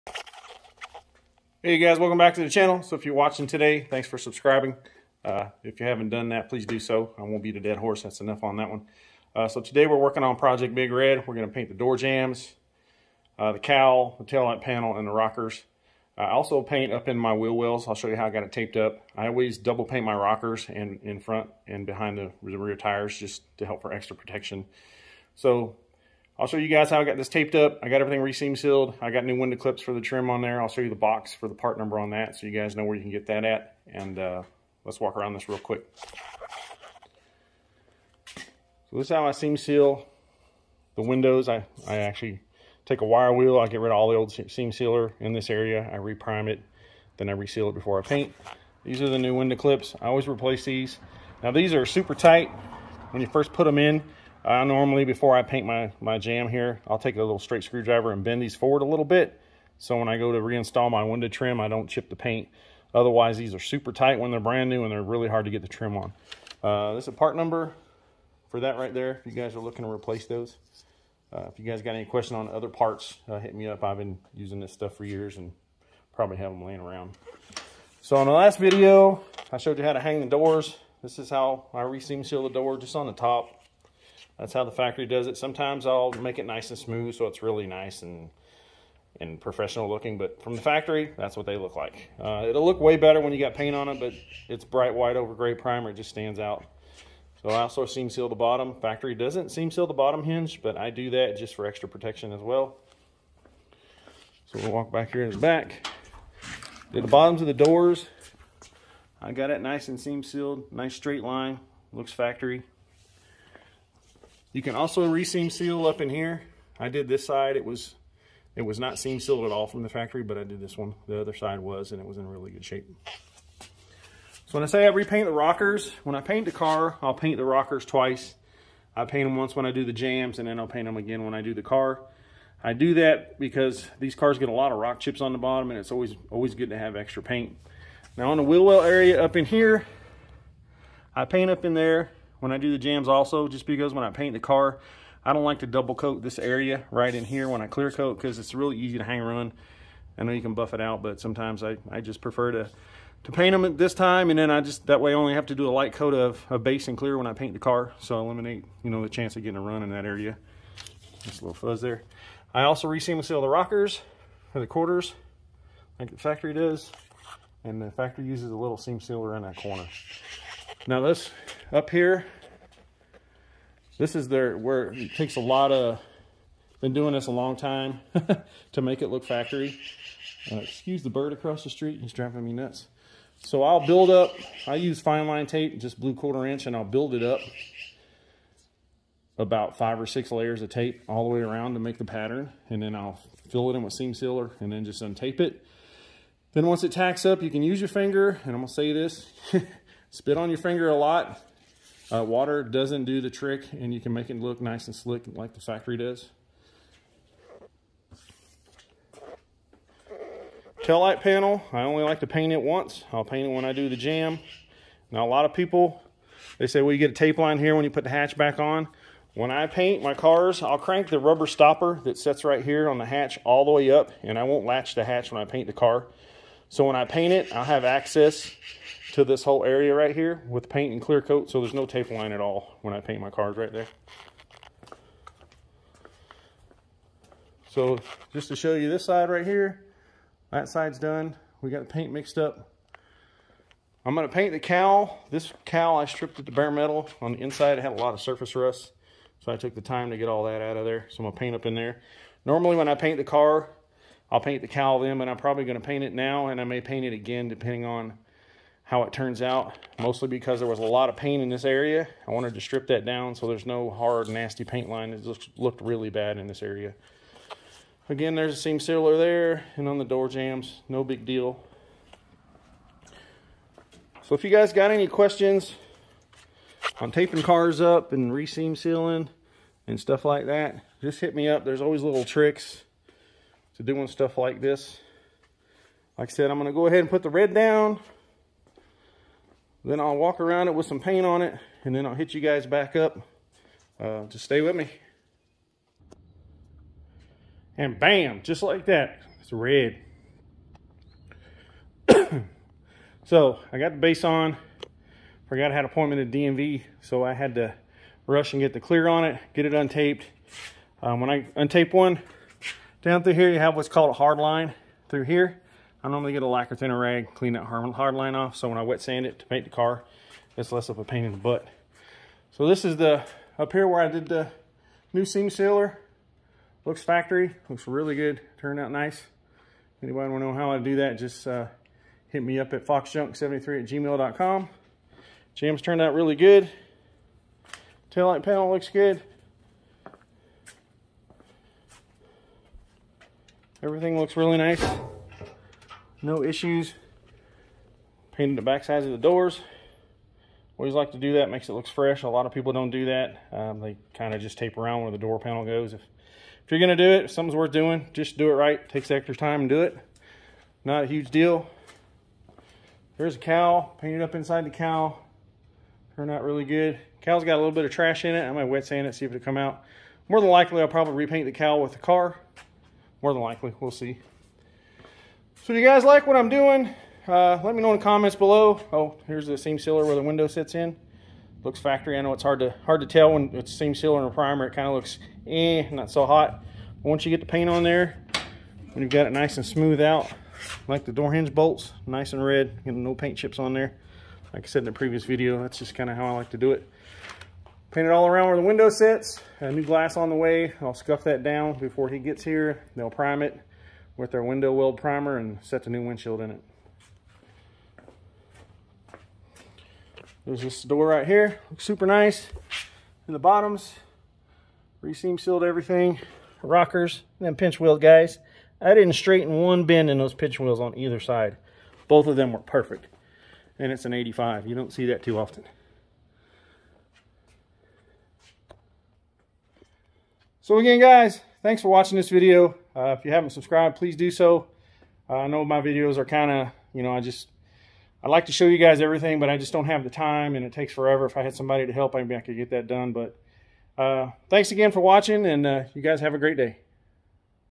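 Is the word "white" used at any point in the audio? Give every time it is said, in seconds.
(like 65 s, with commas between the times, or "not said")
94 s.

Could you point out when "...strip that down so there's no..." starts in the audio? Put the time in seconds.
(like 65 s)
262 s.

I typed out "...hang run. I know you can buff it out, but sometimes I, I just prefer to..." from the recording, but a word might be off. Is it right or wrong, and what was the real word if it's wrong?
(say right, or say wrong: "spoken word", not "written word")
right.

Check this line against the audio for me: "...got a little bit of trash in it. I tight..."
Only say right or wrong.
wrong.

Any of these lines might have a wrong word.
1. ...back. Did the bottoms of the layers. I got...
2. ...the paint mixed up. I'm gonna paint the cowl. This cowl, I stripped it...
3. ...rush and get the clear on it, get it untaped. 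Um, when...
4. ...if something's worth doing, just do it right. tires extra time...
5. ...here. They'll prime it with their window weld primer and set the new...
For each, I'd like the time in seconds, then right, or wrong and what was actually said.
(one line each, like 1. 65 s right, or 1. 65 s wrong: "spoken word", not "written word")
1. 105 s wrong: "doors", not "layers"
2. 241 s right
3. 308 s right
4. 357 s wrong: "takes", not "tires"
5. 402 s right.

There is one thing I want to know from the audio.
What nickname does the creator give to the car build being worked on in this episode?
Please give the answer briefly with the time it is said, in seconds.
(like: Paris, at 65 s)
Project Big Red, at 10 s.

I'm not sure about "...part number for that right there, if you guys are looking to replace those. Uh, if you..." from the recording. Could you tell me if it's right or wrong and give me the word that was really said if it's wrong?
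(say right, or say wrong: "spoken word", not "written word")
right.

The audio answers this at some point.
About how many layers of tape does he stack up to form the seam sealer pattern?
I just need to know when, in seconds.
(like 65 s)
189 s.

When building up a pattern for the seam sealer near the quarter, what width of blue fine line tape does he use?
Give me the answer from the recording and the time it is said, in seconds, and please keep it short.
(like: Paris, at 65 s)
quarter inch, at 186 s.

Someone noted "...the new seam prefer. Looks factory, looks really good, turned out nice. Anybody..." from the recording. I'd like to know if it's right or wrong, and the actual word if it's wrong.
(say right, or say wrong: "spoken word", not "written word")
wrong: "sealer", not "prefer".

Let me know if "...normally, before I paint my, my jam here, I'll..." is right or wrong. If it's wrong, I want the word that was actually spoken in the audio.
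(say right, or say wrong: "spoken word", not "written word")
right.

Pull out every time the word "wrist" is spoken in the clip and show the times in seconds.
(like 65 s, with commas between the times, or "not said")
not said.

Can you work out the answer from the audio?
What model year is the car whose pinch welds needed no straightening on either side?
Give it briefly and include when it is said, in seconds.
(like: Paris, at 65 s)
1985, at 424 s.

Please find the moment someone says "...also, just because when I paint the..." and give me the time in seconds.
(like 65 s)
143 s.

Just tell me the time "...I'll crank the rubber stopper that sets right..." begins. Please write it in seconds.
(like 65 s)
220 s.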